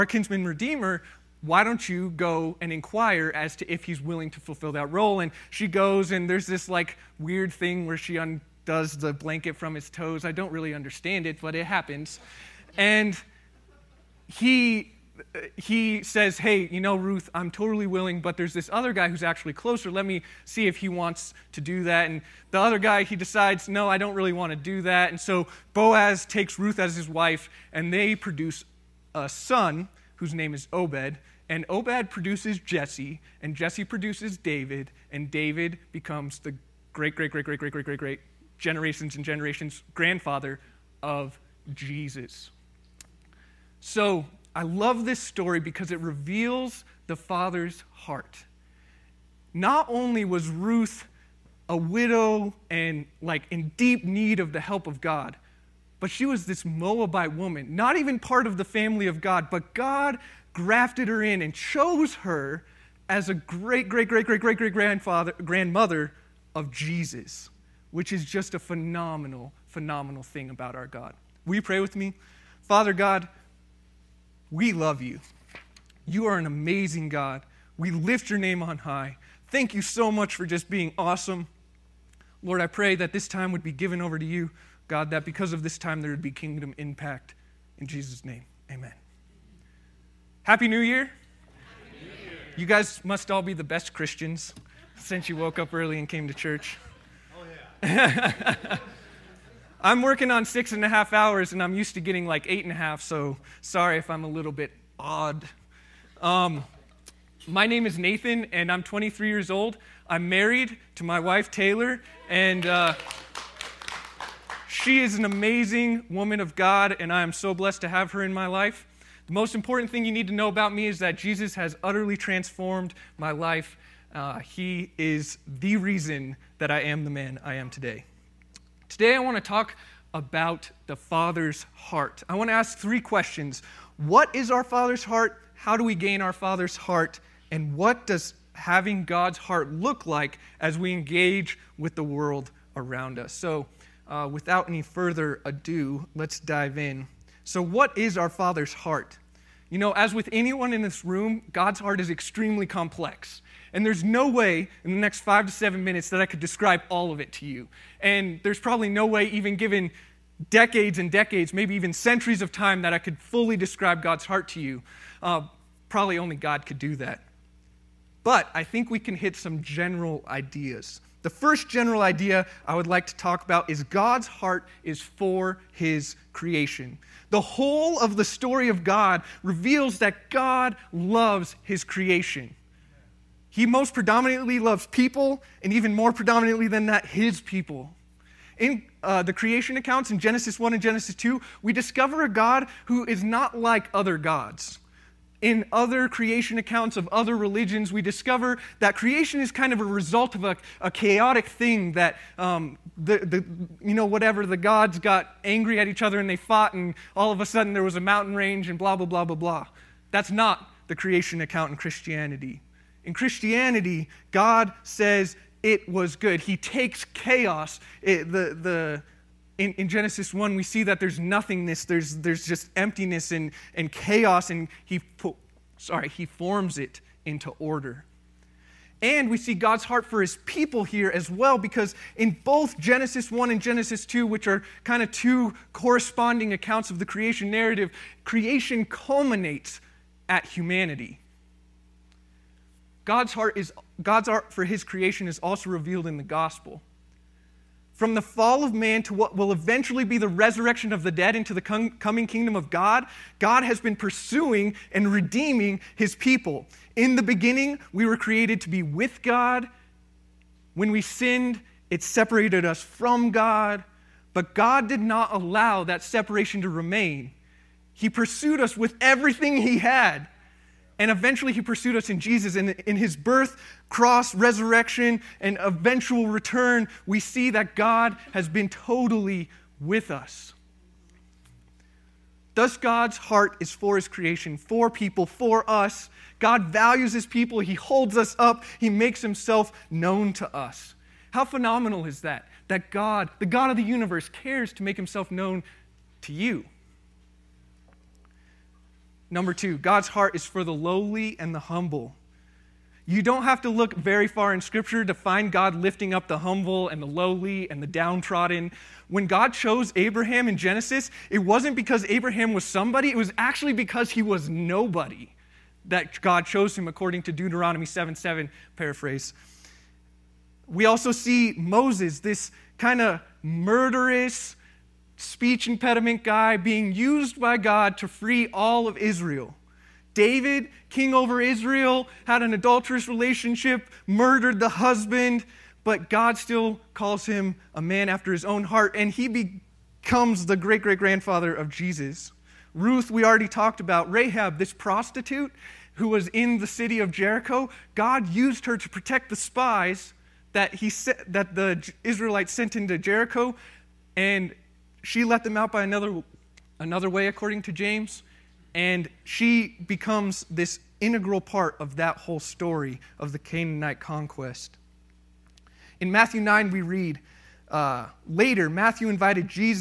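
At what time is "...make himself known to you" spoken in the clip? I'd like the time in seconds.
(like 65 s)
294 s.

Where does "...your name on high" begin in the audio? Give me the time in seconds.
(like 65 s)
78 s.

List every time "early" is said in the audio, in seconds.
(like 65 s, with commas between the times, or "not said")
95 s.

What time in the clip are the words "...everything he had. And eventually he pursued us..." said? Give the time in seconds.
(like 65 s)
269 s.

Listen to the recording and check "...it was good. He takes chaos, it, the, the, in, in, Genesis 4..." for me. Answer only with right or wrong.
wrong.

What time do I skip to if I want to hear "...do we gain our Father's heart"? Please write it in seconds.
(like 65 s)
135 s.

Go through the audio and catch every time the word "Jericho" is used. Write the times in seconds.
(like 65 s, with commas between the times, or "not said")
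347 s, 352 s.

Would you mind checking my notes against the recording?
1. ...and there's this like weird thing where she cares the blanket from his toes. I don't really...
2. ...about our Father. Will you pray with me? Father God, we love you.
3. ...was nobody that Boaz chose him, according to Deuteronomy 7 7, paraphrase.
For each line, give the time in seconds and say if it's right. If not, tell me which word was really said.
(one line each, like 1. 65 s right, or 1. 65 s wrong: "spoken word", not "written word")
1. 6 s wrong: "undoes", not "cares"
2. 70 s wrong: "God", not "Father"
3. 314 s wrong: "God", not "Boaz".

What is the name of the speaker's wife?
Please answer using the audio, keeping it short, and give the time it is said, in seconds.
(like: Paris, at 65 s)
Taylor, at 111 s.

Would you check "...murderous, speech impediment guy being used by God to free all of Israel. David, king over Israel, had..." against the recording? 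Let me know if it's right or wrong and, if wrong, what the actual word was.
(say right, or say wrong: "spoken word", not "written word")
right.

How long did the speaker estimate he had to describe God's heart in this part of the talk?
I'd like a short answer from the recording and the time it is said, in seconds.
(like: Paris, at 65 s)
5 to 7 minutes, at 155 s.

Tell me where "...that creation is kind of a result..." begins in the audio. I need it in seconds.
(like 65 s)
198 s.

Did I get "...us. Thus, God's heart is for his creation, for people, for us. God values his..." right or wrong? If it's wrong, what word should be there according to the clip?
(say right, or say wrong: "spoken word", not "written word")
right.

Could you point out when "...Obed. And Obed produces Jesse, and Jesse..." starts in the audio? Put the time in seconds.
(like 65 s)
30 s.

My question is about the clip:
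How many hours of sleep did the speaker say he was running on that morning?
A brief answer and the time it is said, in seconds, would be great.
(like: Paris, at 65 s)
6.5, at 100 s.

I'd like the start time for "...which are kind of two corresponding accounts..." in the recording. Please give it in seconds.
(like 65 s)
234 s.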